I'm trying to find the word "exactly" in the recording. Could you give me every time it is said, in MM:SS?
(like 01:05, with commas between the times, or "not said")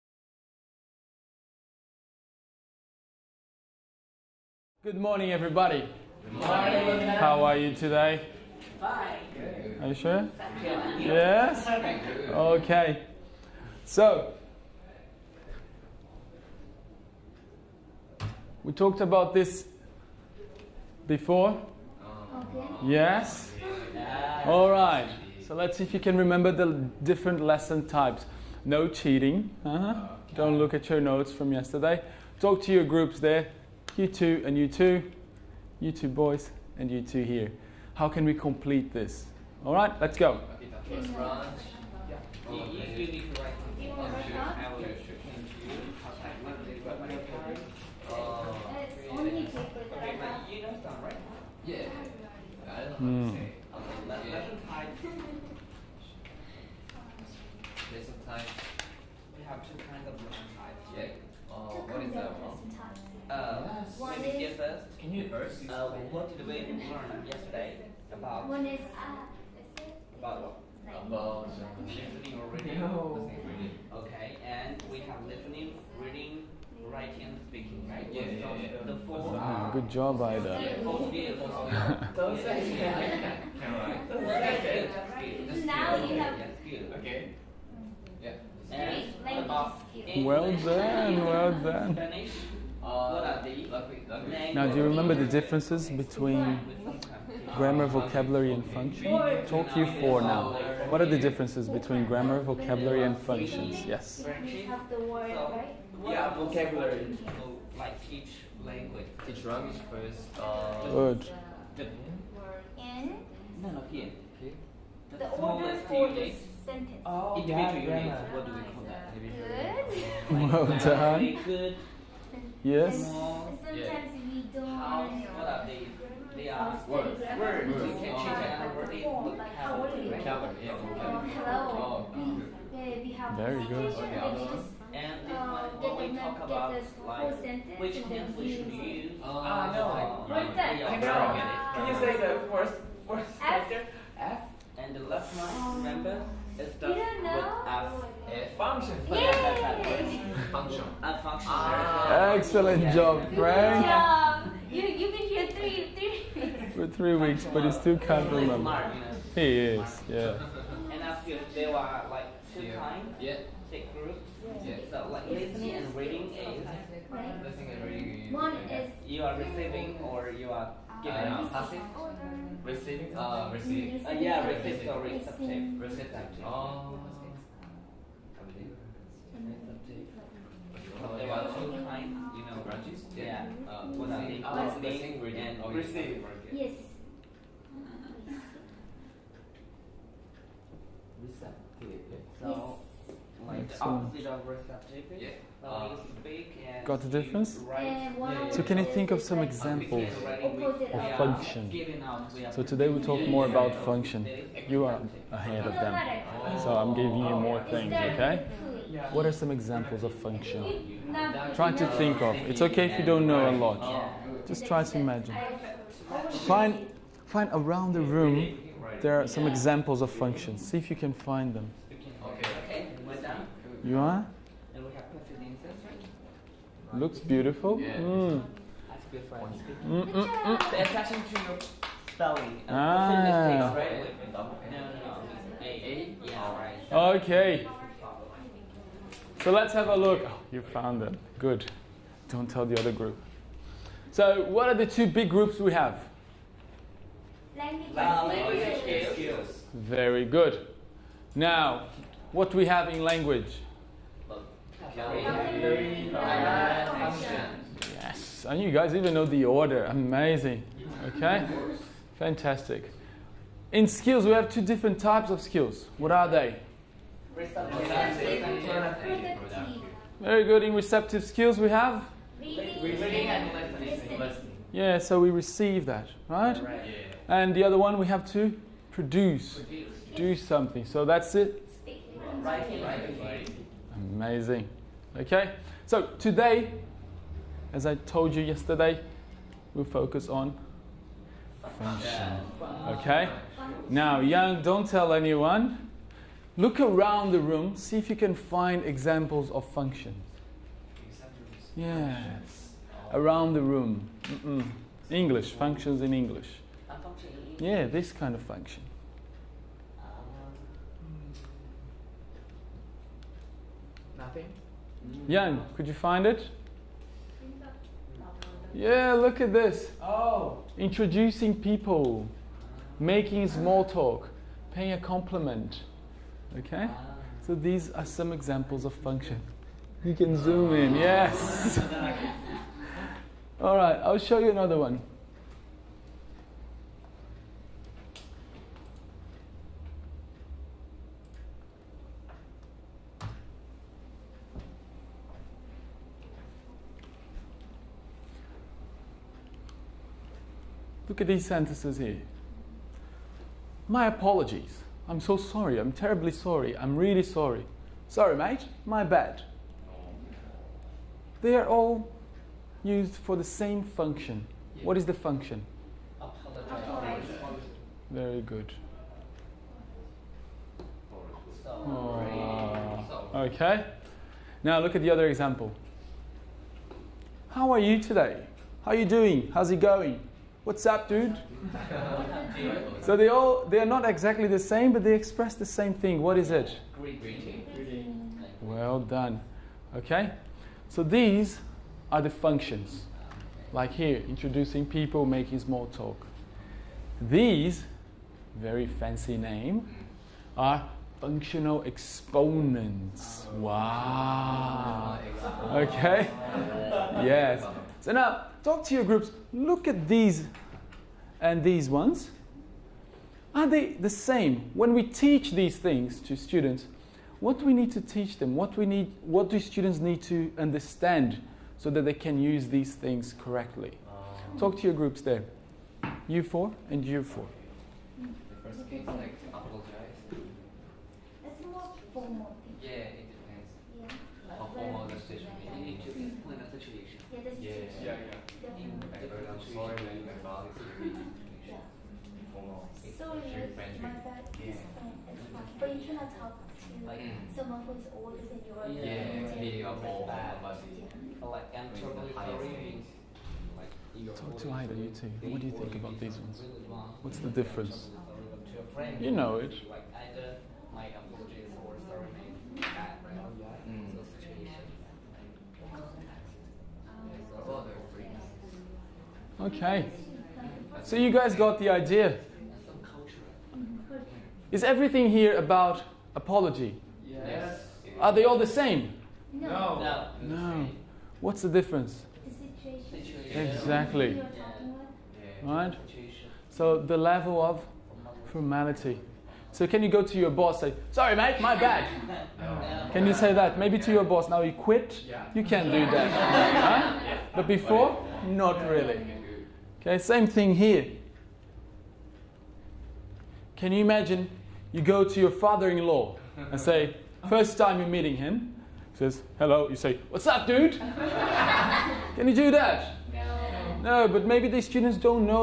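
06:24, 08:03.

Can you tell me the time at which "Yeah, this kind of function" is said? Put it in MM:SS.
05:07.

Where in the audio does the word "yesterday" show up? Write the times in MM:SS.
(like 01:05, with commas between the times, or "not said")
00:31, 01:07, 04:48.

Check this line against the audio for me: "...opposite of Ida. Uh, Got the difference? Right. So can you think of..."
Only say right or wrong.
wrong.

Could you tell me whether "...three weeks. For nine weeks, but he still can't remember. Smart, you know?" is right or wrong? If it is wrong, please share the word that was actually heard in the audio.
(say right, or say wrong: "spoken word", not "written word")
wrong: "three", not "nine".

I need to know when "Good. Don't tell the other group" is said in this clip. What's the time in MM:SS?
04:01.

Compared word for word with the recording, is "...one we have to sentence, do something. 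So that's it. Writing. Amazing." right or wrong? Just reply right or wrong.
wrong.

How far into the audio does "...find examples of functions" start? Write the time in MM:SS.
04:58.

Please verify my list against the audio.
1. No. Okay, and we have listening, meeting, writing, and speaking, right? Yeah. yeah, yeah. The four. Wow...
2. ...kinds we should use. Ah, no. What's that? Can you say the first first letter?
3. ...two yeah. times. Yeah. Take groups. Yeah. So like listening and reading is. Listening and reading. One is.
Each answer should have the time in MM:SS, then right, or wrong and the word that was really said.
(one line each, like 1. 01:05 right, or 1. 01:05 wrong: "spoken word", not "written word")
1. 01:12 wrong: "reading", not "meeting"
2. 02:18 wrong: "hands", not "kinds"
3. 02:42 right.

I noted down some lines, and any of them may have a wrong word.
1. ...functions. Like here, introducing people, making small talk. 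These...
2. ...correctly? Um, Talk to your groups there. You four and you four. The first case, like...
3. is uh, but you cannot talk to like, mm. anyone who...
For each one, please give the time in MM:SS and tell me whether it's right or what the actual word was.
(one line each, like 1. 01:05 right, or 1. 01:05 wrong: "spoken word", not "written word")
1. 06:32 right
2. 07:03 right
3. 07:24 wrong: "someone", not "anyone".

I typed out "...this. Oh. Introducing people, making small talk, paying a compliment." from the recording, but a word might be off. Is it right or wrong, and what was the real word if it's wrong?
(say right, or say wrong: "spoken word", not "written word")
right.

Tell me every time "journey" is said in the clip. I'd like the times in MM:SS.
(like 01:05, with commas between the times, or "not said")
not said.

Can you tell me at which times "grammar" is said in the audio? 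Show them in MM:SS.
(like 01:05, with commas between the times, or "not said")
01:37, 01:42.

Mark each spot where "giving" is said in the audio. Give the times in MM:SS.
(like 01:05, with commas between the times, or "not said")
02:51, 03:26.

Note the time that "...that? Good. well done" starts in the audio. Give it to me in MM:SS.
01:58.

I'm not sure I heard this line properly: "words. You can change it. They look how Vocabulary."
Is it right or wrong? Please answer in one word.
right.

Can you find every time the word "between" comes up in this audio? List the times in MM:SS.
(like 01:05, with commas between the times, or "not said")
01:35, 01:41.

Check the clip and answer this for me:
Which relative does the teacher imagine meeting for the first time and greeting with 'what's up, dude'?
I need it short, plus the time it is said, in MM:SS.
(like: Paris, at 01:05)
father in law, at 08:25.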